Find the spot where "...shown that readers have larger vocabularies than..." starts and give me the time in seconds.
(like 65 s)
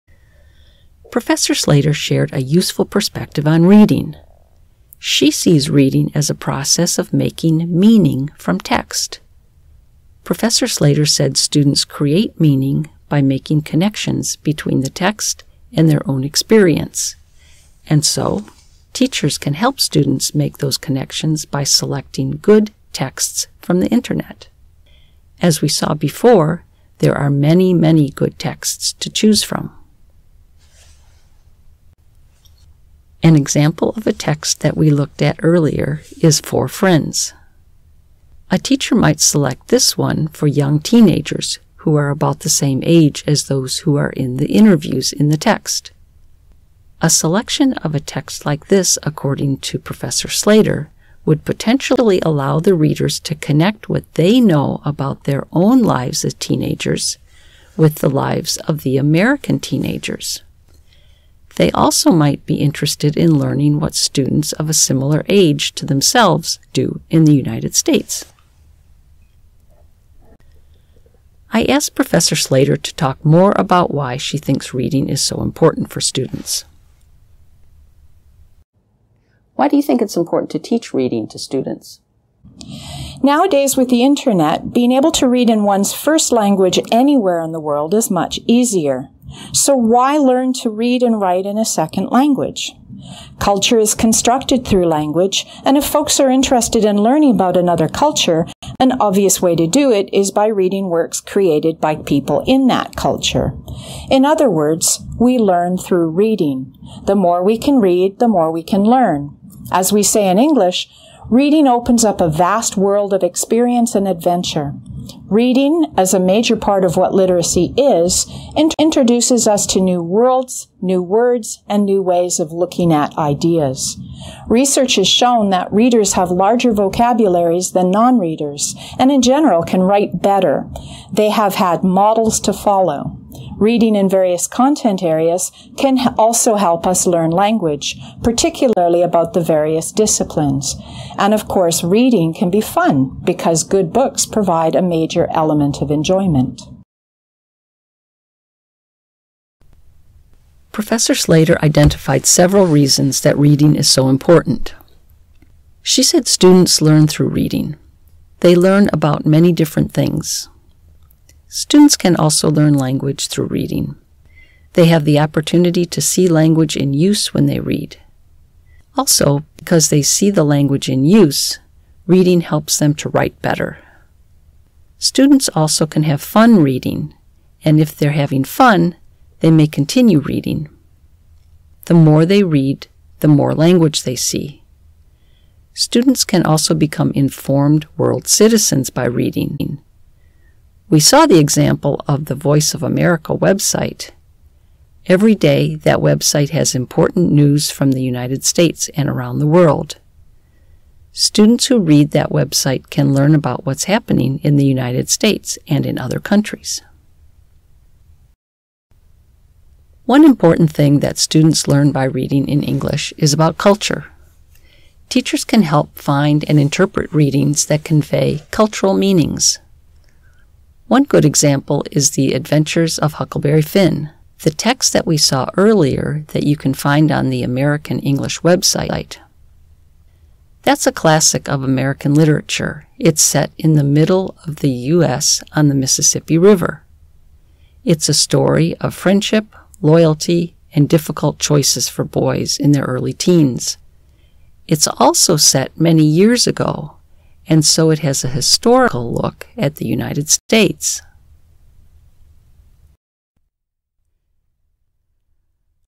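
125 s.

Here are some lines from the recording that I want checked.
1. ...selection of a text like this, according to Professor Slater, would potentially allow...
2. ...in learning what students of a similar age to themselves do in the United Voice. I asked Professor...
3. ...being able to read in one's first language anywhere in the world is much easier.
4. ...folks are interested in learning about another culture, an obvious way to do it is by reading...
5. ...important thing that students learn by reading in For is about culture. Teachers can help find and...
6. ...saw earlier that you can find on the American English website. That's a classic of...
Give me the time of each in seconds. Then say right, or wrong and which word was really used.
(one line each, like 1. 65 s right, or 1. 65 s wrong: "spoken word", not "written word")
1. 47 s right
2. 63 s wrong: "States", not "Voice"
3. 84 s right
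4. 95 s right
5. 210 s wrong: "English", not "For"
6. 225 s right.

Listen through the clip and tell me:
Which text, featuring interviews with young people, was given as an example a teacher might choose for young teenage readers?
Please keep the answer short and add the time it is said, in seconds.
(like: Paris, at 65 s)
For Friends, at 36 s.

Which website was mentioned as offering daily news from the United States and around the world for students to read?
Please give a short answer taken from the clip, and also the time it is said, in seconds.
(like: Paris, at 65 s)
Voice of America, at 192 s.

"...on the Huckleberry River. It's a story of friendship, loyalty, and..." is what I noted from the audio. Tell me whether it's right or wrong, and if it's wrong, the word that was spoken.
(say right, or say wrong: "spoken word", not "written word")
wrong: "Mississippi", not "Huckleberry".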